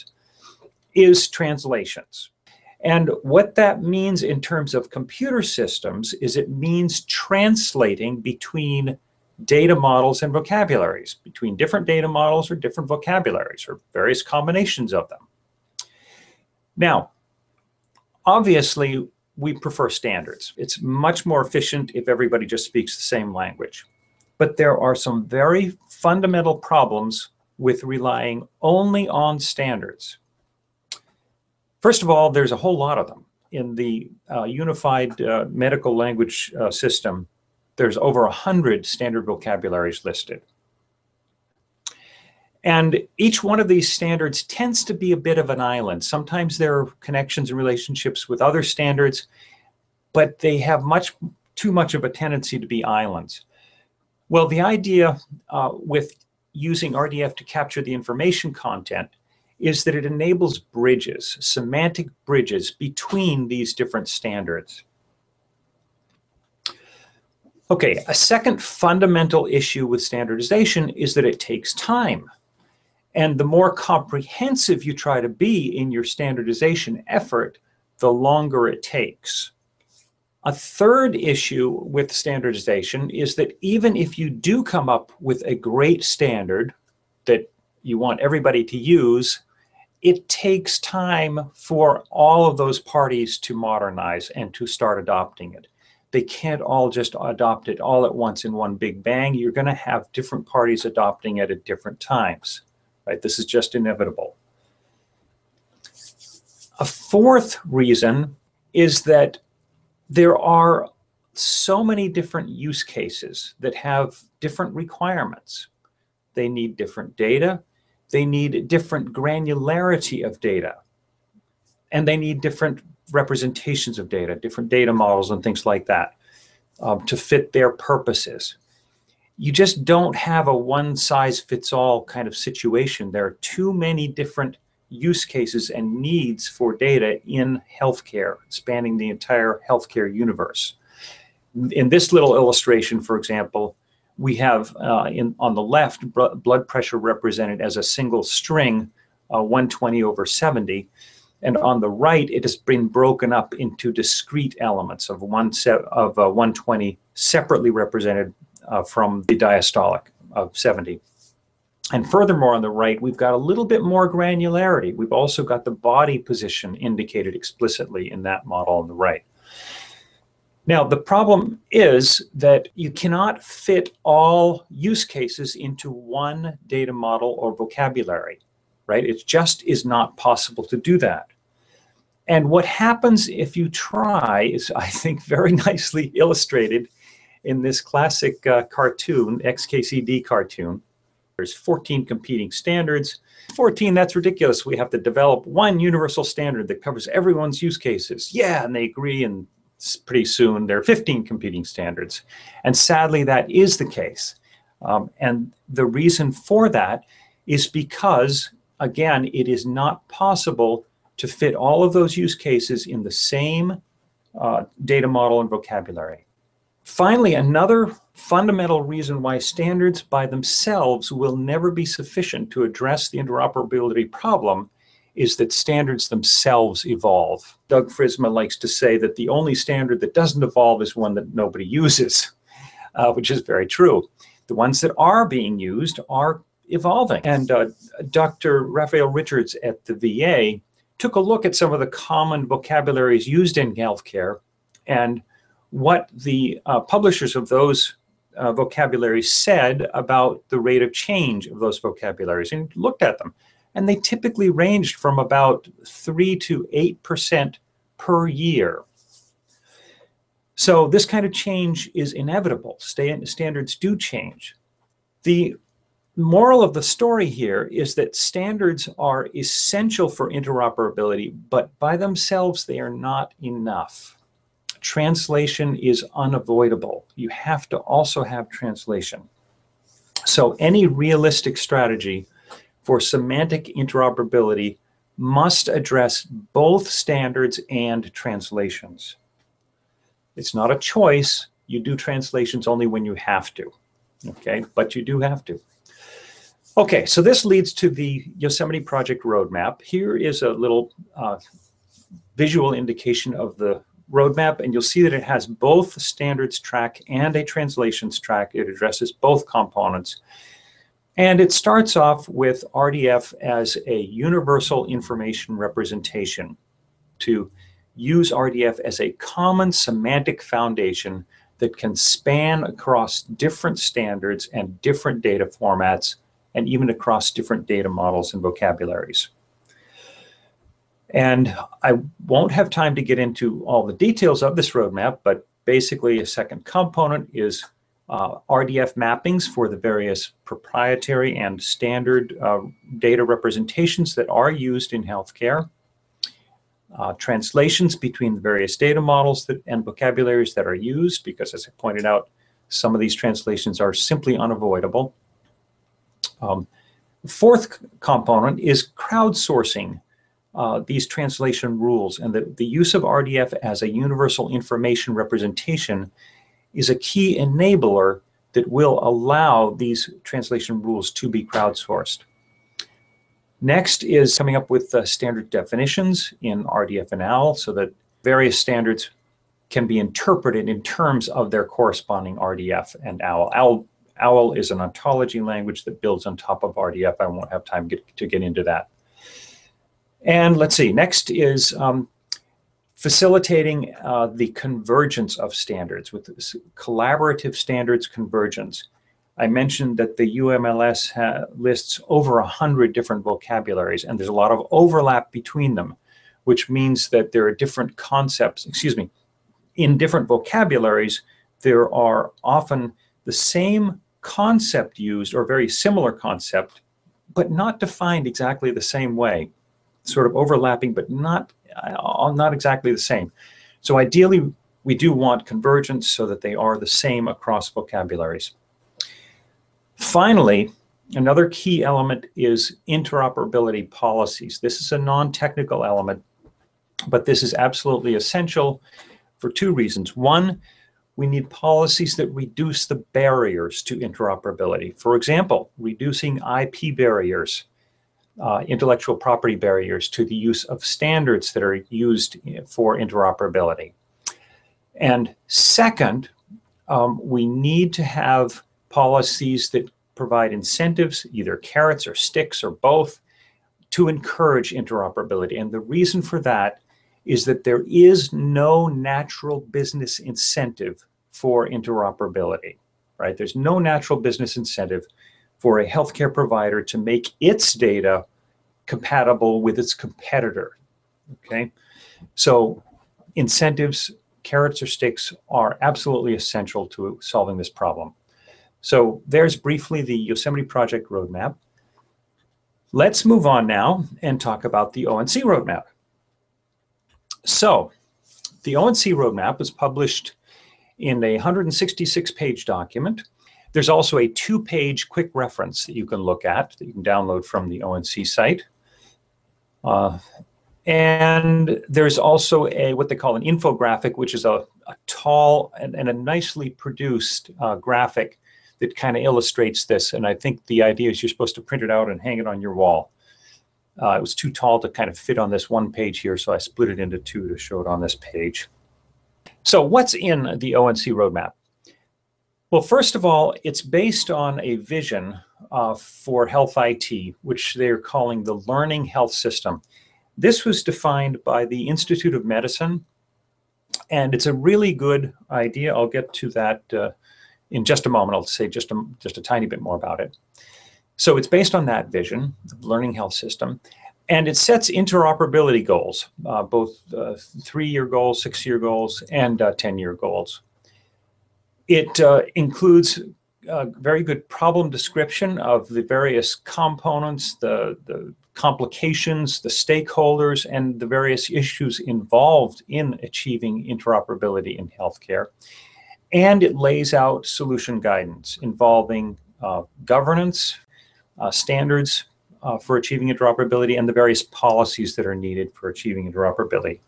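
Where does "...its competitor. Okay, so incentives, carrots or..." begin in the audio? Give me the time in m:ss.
7:59.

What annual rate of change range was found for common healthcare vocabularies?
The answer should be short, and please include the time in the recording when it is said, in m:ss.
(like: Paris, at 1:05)
3 to 8%, at 4:15.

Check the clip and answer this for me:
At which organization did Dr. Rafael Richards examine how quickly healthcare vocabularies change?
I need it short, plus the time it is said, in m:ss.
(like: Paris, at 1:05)
the VA, at 3:59.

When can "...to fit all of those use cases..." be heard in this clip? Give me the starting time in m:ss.
3:31.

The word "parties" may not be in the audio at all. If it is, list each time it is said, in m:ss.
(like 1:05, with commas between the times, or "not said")
1:32, 1:40.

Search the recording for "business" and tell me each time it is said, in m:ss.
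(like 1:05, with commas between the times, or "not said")
7:49, 7:54.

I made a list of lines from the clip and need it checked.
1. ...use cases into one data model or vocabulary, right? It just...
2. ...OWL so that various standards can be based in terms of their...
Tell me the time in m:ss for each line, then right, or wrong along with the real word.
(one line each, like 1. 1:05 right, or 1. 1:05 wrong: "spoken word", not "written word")
1. 2:54 right
2. 6:17 wrong: "interpreted", not "based".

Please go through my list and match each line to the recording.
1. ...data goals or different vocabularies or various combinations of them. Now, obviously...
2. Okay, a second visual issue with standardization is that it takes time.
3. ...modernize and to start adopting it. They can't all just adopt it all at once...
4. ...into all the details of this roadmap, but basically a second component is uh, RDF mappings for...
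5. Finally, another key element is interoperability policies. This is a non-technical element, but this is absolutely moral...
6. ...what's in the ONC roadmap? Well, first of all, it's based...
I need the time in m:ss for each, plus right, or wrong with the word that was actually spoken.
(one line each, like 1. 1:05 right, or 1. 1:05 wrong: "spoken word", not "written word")
1. 0:11 wrong: "models", not "goals"
2. 1:07 wrong: "fundamental", not "visual"
3. 1:33 right
4. 5:33 right
5. 7:09 wrong: "essential", not "moral"
6. 8:49 right.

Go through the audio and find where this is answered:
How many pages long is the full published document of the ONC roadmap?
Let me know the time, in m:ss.
8:21.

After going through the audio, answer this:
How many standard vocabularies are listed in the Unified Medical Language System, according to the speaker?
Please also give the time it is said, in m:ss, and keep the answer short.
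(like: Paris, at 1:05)
over 100, at 0:37.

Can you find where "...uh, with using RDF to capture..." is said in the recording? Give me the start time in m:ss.
0:55.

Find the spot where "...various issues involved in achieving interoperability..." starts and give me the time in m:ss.
9:31.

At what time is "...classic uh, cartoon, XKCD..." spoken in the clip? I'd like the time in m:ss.
3:07.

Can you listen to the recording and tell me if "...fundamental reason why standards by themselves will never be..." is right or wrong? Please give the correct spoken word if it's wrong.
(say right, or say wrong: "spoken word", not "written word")
right.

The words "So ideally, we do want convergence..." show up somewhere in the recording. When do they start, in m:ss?
7:03.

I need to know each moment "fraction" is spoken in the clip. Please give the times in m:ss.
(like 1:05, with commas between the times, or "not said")
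not said.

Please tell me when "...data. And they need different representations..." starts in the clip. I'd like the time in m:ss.
2:00.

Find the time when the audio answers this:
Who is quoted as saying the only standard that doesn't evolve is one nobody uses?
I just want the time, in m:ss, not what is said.
3:47.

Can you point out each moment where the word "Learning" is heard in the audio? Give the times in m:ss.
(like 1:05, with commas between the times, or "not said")
8:58, 9:12.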